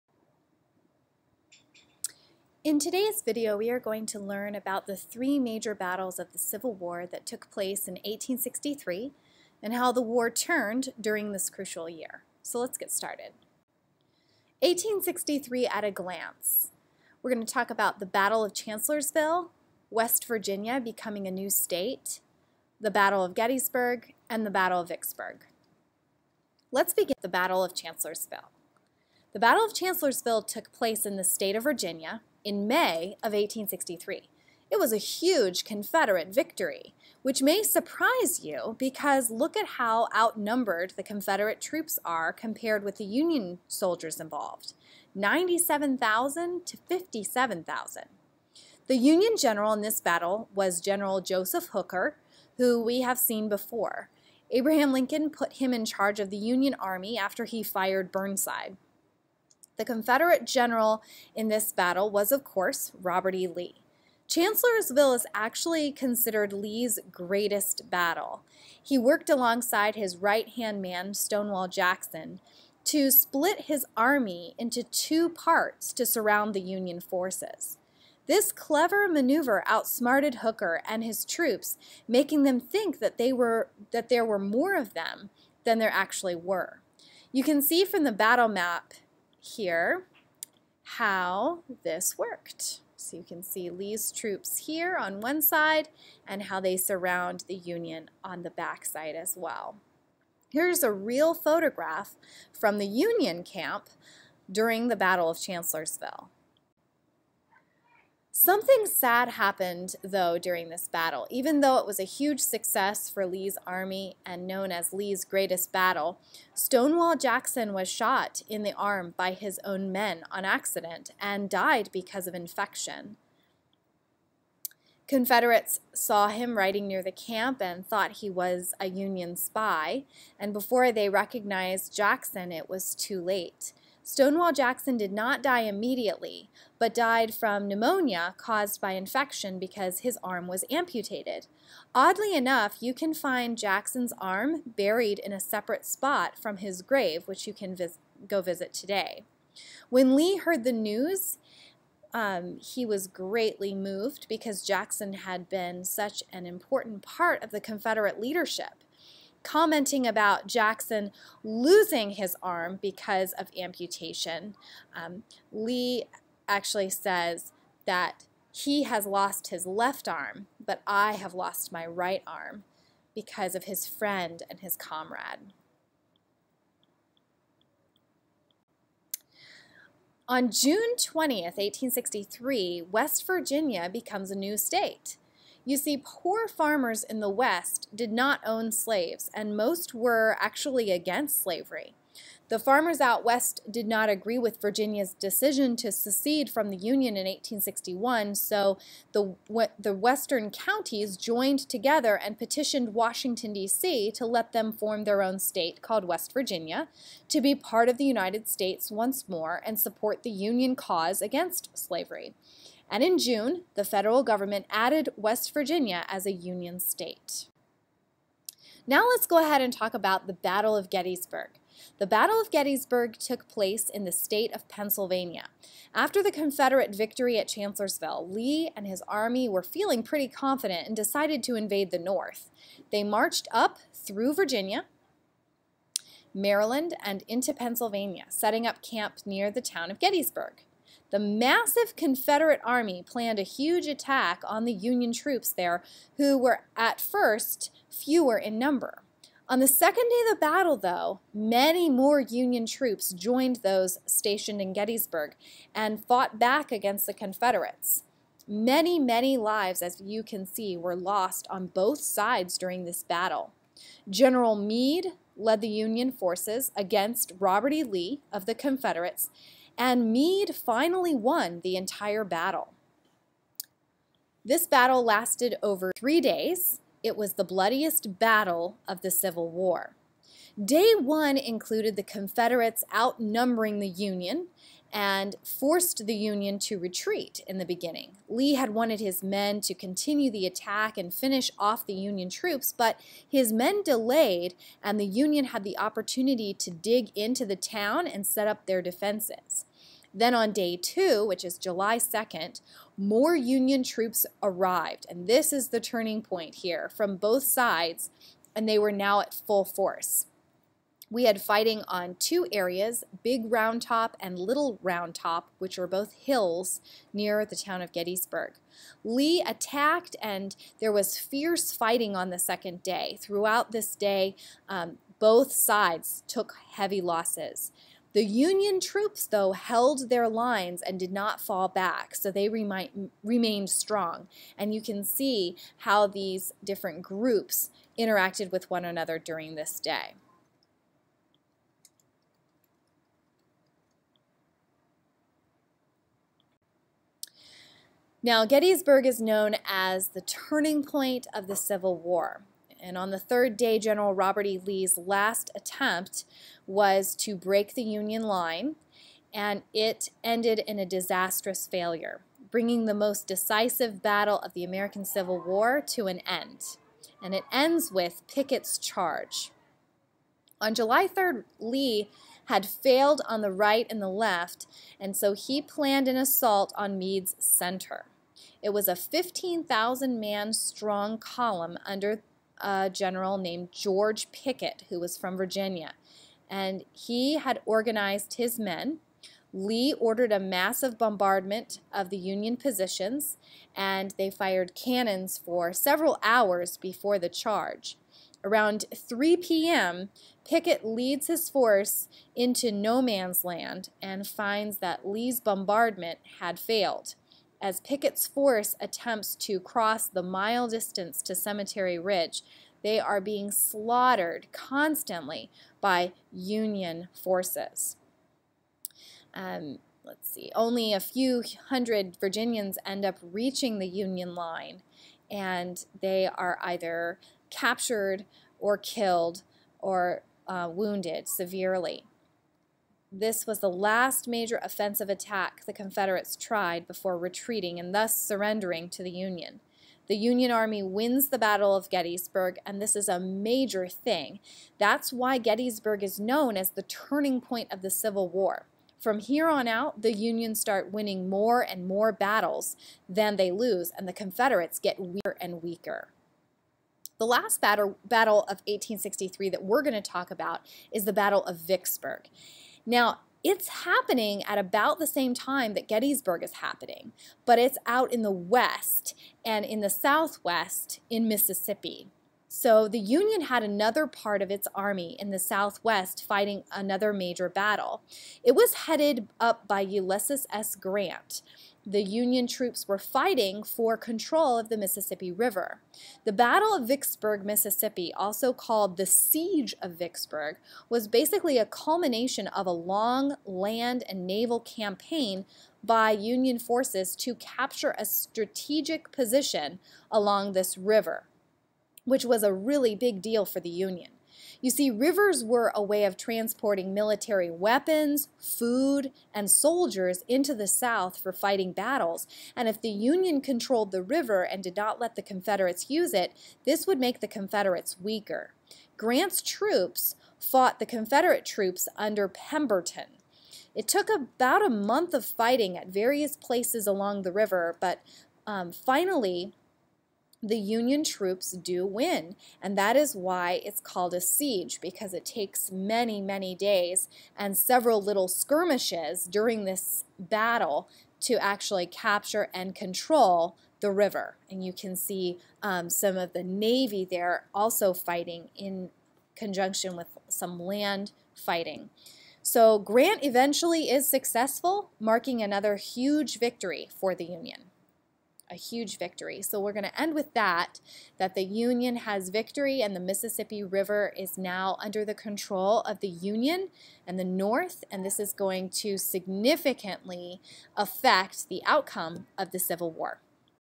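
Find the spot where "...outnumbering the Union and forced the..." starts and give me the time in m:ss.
4:42.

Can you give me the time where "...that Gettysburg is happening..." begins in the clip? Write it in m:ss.
7:45.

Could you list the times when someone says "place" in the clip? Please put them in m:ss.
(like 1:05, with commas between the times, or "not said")
0:07, 0:30, 3:43, 8:46.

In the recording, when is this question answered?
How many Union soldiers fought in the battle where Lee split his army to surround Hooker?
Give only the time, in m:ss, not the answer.
0:45.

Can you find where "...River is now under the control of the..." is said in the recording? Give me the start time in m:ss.
9:23.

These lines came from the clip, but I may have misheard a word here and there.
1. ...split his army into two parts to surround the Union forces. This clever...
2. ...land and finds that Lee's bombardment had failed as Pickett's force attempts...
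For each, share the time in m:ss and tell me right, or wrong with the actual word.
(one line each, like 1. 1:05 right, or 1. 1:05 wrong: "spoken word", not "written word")
1. 1:13 right
2. 6:43 right.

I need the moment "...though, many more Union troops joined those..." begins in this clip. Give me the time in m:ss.
4:10.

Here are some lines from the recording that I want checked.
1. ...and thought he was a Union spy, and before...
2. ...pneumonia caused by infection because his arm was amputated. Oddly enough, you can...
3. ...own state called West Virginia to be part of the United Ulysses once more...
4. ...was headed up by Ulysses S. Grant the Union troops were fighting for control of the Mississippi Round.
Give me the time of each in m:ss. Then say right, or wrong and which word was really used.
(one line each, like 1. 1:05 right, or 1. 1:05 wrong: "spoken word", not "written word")
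1. 2:07 right
2. 2:17 right
3. 3:25 wrong: "States", not "Ulysses"
4. 7:58 wrong: "River", not "Round".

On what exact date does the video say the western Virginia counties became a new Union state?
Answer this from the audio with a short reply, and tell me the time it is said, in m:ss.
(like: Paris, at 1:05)
June 20th, 1863, at 3:00.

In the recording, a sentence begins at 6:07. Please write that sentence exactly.
And it ends with Pickett's charge.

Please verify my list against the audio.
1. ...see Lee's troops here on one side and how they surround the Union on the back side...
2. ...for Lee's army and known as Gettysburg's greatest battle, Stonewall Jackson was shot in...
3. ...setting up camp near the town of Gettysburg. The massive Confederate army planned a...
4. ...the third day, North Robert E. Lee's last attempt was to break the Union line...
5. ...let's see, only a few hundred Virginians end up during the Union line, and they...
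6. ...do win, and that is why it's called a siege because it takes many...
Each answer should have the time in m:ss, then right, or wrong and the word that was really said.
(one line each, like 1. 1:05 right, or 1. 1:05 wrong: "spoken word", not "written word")
1. 1:33 right
2. 1:53 wrong: "Lee", not "Gettysburg"
3. 3:58 right
4. 5:53 wrong: "General", not "North"
5. 7:00 wrong: "reaching", not "during"
6. 8:51 right.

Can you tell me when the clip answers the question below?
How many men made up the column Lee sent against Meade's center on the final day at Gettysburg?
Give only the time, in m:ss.
6:18.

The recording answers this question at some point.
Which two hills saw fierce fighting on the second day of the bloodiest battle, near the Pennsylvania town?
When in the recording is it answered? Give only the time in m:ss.
5:13.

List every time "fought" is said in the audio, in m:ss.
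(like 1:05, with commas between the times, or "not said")
4:16, 8:40.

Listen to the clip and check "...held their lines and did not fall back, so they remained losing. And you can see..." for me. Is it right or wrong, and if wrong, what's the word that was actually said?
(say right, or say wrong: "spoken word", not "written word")
wrong: "strong", not "losing".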